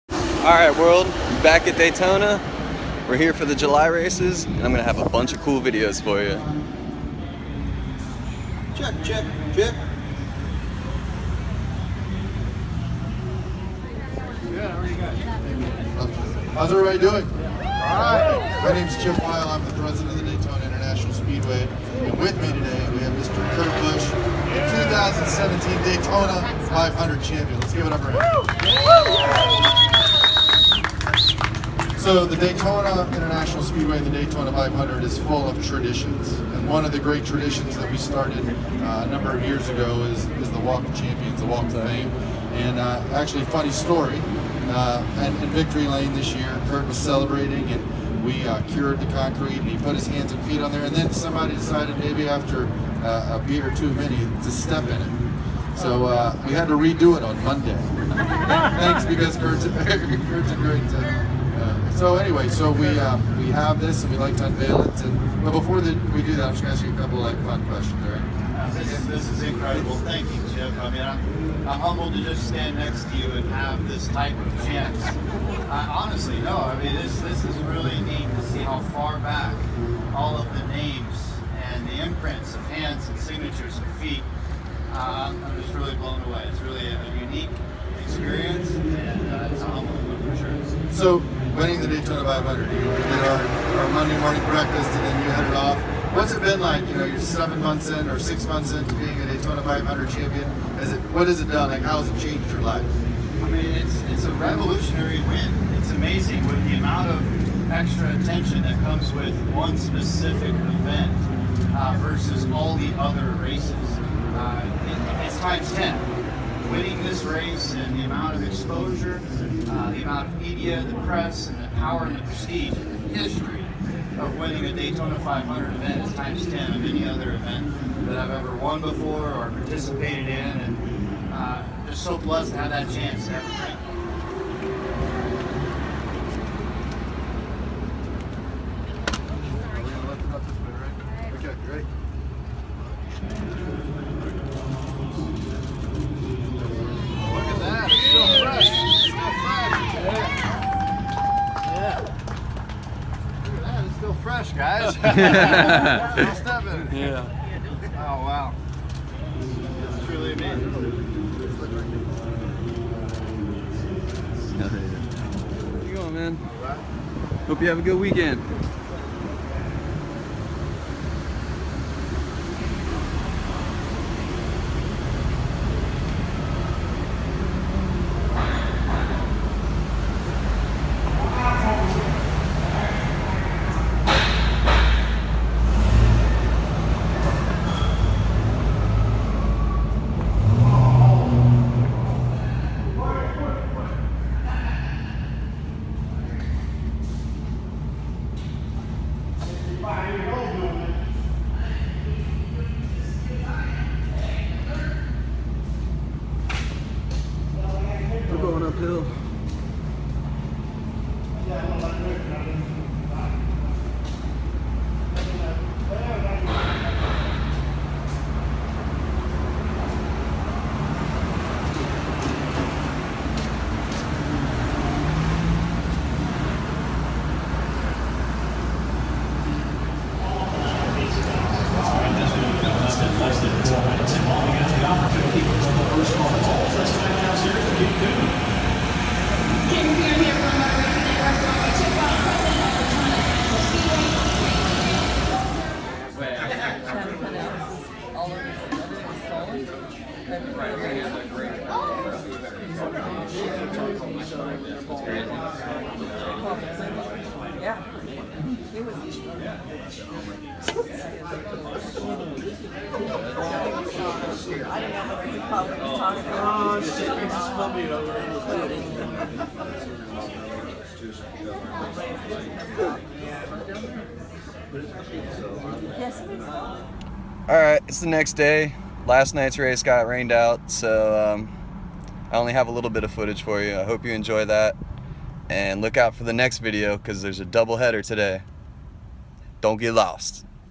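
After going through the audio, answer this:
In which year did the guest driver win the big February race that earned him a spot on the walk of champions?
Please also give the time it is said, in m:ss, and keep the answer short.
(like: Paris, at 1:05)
2017, at 0:24.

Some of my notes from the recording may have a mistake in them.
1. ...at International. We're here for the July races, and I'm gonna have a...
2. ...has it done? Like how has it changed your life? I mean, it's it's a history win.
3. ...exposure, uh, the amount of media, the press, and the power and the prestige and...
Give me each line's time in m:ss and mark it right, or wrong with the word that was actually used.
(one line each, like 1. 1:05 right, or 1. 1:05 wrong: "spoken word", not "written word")
1. 0:01 wrong: "Daytona", not "International"
2. 1:41 wrong: "revolutionary", not "history"
3. 1:58 right.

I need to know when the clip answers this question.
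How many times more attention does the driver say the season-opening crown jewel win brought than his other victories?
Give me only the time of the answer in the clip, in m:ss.
1:55.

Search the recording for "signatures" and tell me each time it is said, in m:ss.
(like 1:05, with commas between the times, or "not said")
1:23.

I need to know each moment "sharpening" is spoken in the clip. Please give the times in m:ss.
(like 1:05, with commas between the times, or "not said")
not said.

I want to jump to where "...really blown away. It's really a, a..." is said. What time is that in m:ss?
1:25.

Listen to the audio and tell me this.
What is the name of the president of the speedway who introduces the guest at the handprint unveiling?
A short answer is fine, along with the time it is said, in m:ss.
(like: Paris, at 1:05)
Chip Wile, at 0:19.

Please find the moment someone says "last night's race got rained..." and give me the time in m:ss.
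4:39.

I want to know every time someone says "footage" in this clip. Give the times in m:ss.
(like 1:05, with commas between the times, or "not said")
4:43.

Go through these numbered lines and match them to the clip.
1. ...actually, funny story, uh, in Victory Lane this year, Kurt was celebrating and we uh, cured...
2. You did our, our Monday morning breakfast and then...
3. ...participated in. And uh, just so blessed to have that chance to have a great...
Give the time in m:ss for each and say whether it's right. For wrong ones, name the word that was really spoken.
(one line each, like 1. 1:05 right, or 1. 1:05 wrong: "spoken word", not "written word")
1. 0:43 right
2. 1:32 right
3. 2:09 right.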